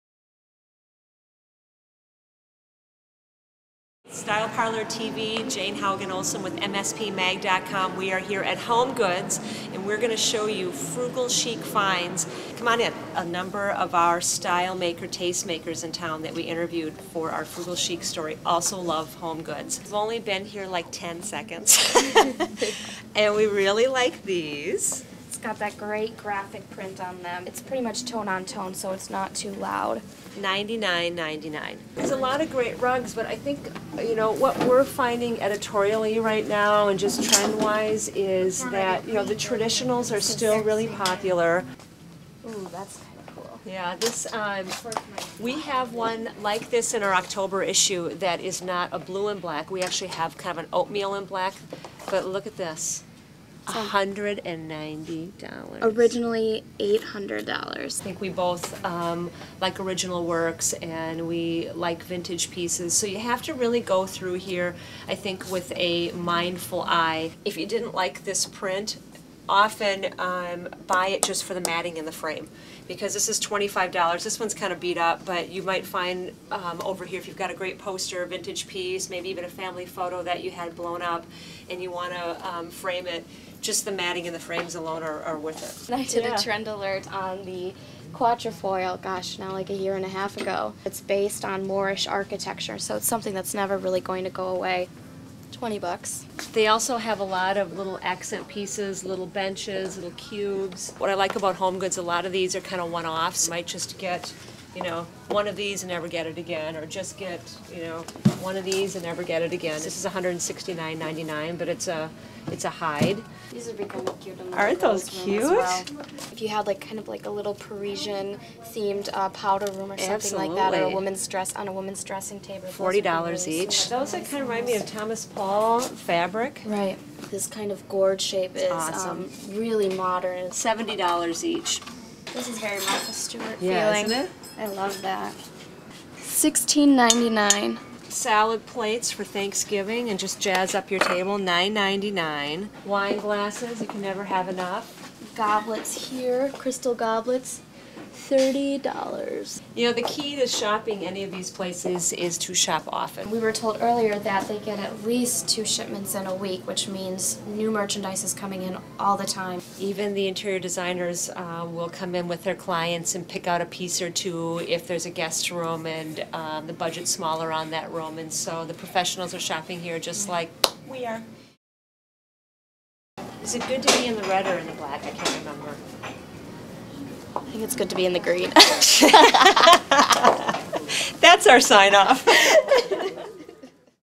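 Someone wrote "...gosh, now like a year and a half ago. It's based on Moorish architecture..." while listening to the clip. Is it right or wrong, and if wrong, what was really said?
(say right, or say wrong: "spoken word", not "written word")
right.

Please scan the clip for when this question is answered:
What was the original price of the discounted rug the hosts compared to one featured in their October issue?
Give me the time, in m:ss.
0:55.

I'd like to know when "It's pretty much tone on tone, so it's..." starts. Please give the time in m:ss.
0:27.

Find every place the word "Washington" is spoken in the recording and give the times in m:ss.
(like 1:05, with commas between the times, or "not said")
not said.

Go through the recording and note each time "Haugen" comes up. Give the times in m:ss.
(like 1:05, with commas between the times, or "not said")
0:05.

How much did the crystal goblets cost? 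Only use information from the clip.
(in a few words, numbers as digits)
$30.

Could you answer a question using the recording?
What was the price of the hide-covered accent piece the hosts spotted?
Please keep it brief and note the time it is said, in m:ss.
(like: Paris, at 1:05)
$169.99, at 1:50.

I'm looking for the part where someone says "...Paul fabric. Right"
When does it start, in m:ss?
2:05.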